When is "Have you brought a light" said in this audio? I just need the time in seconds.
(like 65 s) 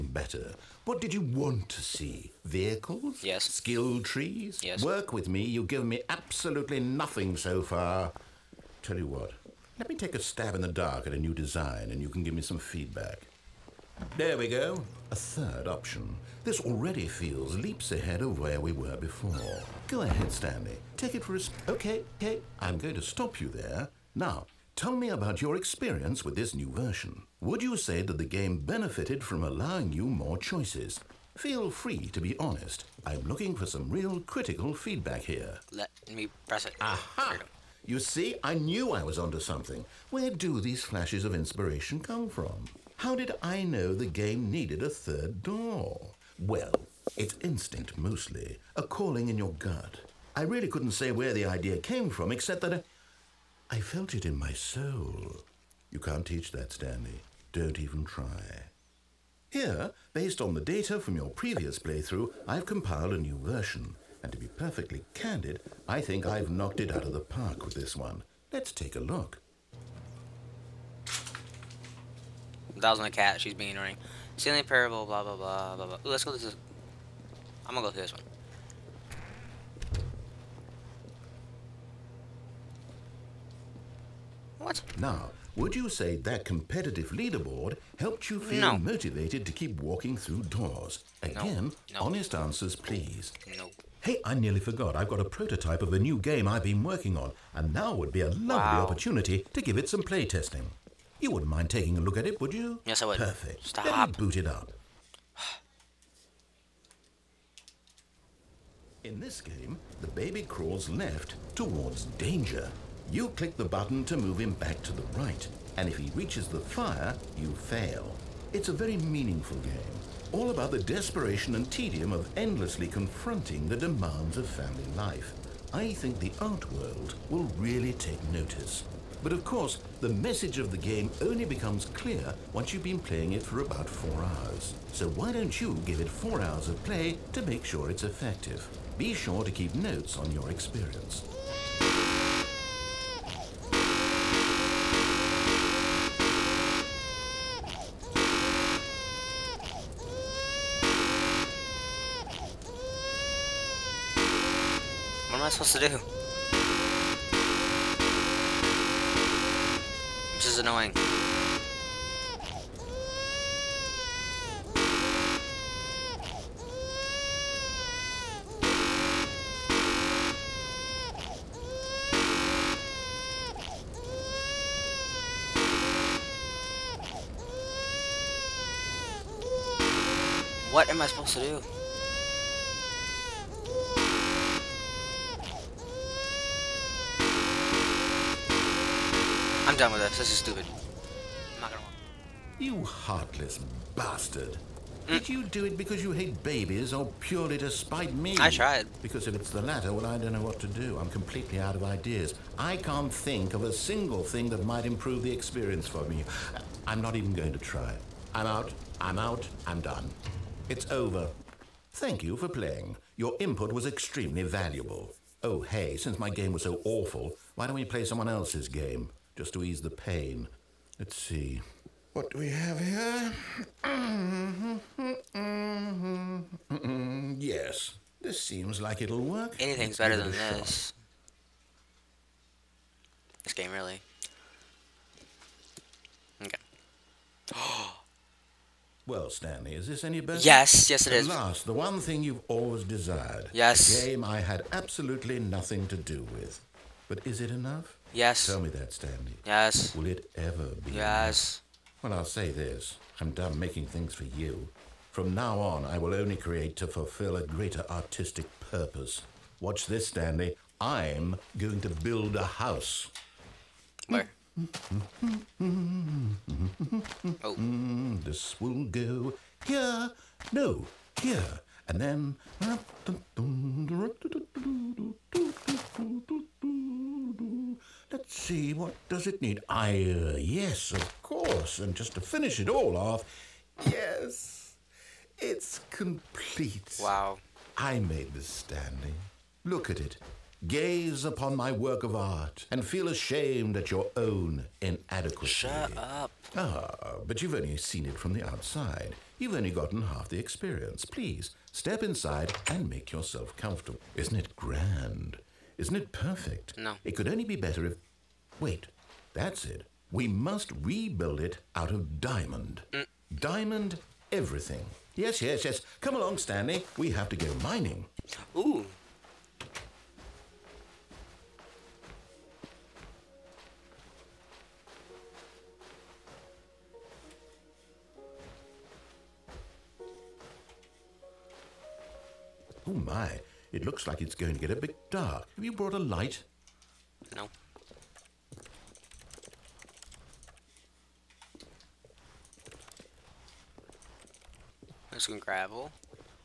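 335 s.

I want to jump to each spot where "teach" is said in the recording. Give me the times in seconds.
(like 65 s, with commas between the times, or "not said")
56 s.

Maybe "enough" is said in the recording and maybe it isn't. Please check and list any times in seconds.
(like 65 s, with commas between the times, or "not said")
247 s, 252 s.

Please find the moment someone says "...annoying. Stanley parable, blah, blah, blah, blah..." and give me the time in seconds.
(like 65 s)
73 s.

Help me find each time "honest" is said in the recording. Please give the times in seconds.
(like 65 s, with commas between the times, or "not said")
32 s, 92 s.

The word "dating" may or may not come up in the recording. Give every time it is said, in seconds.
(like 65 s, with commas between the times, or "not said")
not said.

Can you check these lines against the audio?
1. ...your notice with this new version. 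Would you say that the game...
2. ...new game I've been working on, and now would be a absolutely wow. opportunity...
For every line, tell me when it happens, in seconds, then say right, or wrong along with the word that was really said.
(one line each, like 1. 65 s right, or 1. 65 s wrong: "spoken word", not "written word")
1. 25 s wrong: "experience", not "notice"
2. 95 s wrong: "lovely", not "absolutely".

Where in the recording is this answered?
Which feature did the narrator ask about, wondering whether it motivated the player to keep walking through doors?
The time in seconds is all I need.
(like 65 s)
86 s.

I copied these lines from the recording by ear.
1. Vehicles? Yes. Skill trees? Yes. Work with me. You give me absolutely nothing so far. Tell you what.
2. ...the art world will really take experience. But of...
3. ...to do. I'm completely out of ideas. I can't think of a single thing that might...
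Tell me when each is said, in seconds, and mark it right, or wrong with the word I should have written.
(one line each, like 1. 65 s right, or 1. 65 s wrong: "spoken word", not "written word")
1. 2 s right
2. 126 s wrong: "notice", not "experience"
3. 200 s right.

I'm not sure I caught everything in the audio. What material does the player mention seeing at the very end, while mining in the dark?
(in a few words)
Gravel.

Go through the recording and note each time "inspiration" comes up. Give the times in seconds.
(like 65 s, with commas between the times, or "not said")
41 s.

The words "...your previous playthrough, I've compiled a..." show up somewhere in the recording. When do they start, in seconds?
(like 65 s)
61 s.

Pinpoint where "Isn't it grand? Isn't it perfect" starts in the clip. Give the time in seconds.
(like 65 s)
304 s.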